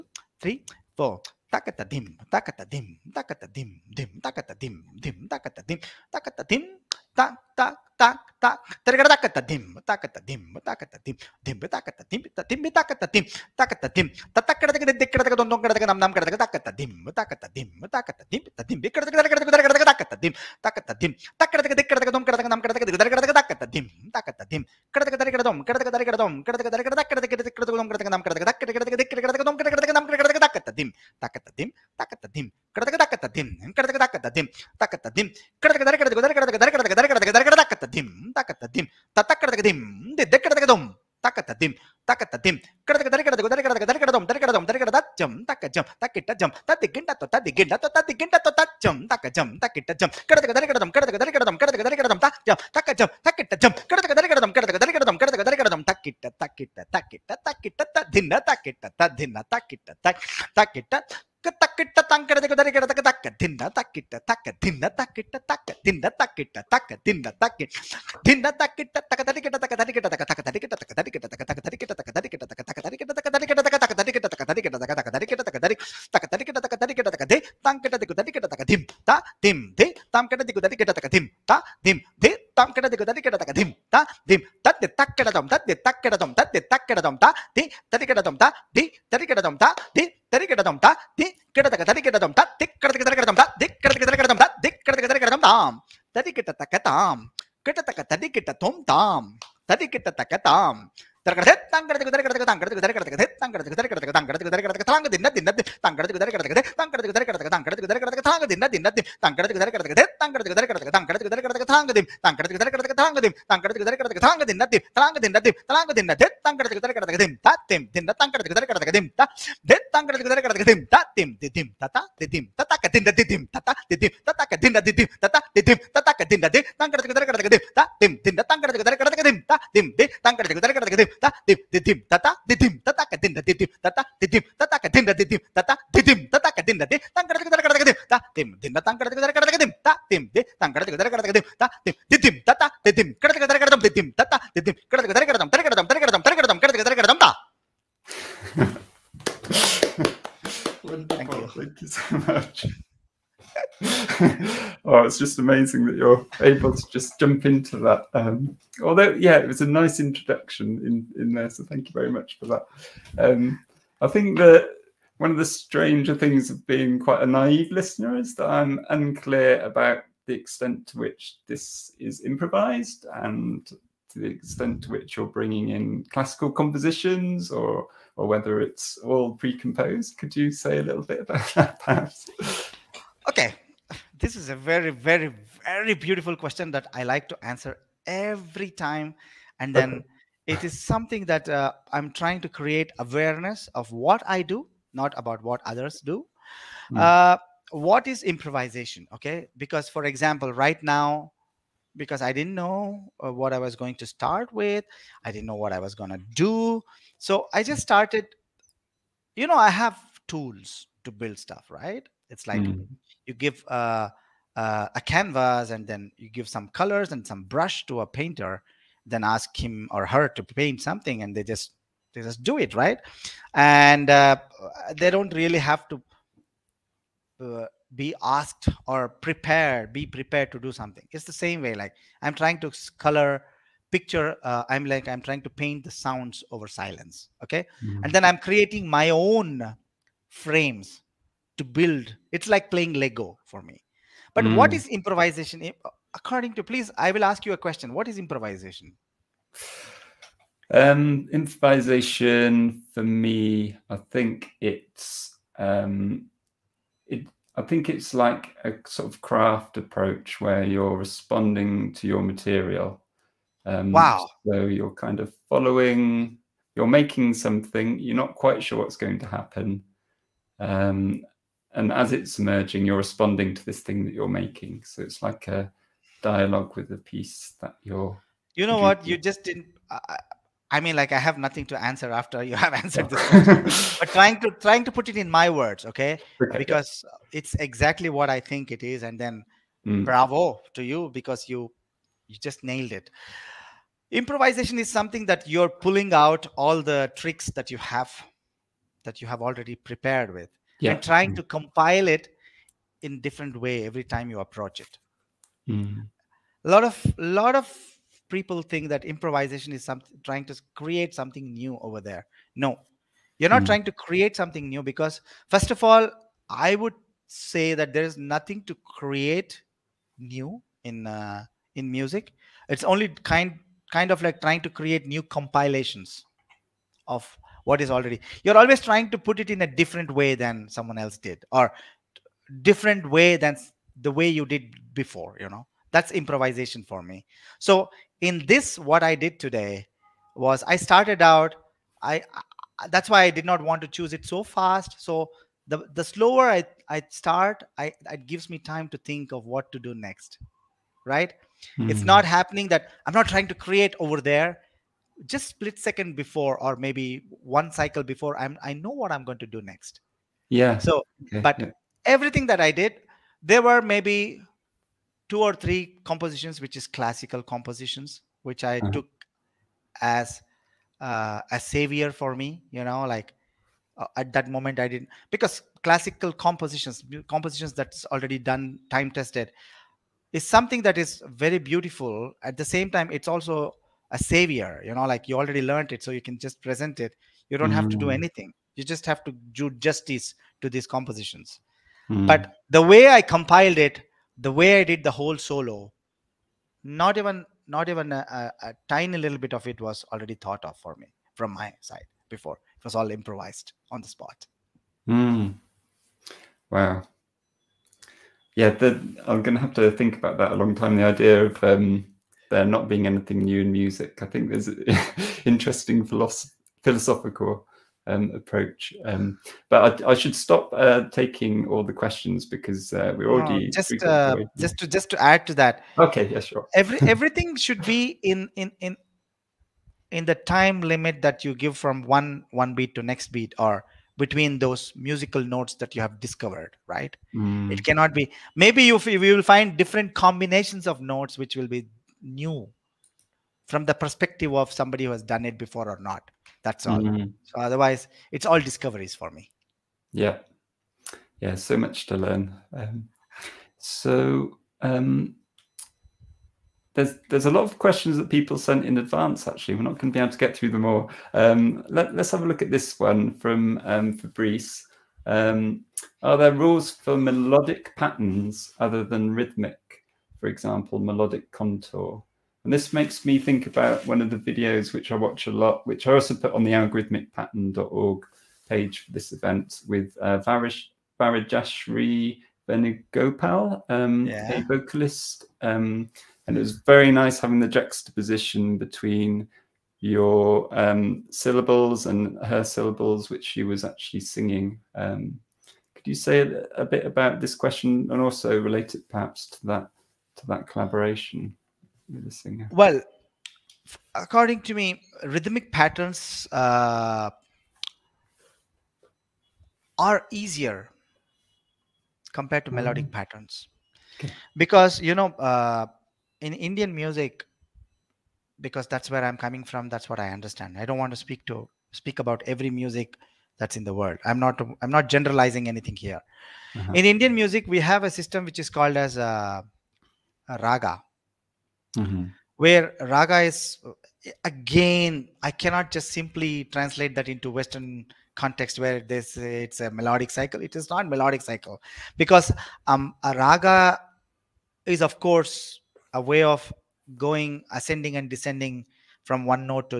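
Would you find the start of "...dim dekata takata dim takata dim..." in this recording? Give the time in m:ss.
0:18.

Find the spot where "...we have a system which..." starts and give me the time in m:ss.
8:47.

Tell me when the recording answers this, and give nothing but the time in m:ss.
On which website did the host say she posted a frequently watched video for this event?
7:56.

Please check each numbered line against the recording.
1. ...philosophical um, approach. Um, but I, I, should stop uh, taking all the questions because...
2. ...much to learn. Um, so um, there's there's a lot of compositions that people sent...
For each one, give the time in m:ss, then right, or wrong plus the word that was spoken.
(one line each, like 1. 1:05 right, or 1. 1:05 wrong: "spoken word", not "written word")
1. 6:56 right
2. 7:31 wrong: "questions", not "compositions".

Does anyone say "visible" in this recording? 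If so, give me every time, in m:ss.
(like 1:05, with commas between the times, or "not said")
not said.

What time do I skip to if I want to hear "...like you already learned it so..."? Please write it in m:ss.
6:25.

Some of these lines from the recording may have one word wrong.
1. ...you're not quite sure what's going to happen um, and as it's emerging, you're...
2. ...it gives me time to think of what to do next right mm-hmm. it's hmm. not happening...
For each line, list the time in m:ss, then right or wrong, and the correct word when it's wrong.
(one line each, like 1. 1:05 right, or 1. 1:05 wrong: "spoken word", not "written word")
1. 4:27 right
2. 5:48 right.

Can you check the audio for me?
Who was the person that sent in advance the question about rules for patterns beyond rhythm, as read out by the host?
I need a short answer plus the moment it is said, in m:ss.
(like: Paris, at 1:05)
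Fabrice, at 7:44.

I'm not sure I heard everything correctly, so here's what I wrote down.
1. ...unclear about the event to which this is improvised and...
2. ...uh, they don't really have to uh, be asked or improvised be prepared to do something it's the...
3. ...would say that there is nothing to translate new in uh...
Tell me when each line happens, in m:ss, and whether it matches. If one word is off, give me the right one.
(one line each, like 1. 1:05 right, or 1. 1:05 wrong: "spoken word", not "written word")
1. 2:48 wrong: "extent", not "event"
2. 3:44 wrong: "prepared", not "improvised"
3. 5:16 wrong: "create", not "translate".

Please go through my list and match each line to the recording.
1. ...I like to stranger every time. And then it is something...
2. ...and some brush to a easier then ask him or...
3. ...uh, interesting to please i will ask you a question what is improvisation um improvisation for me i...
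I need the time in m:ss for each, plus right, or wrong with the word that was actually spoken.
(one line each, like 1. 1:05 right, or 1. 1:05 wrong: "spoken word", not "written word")
1. 3:06 wrong: "answer", not "stranger"
2. 3:37 wrong: "painter", not "easier"
3. 4:05 wrong: "according", not "interesting".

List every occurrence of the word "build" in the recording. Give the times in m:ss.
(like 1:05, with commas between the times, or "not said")
3:31, 4:01.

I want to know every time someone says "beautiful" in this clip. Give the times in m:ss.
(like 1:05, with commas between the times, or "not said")
3:05, 6:21.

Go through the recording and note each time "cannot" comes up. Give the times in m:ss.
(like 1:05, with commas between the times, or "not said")
7:17, 8:55.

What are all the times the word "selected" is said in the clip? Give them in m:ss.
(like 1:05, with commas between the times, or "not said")
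not said.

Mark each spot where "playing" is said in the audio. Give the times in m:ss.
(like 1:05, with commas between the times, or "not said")
4:02.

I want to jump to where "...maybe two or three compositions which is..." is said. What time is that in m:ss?
6:03.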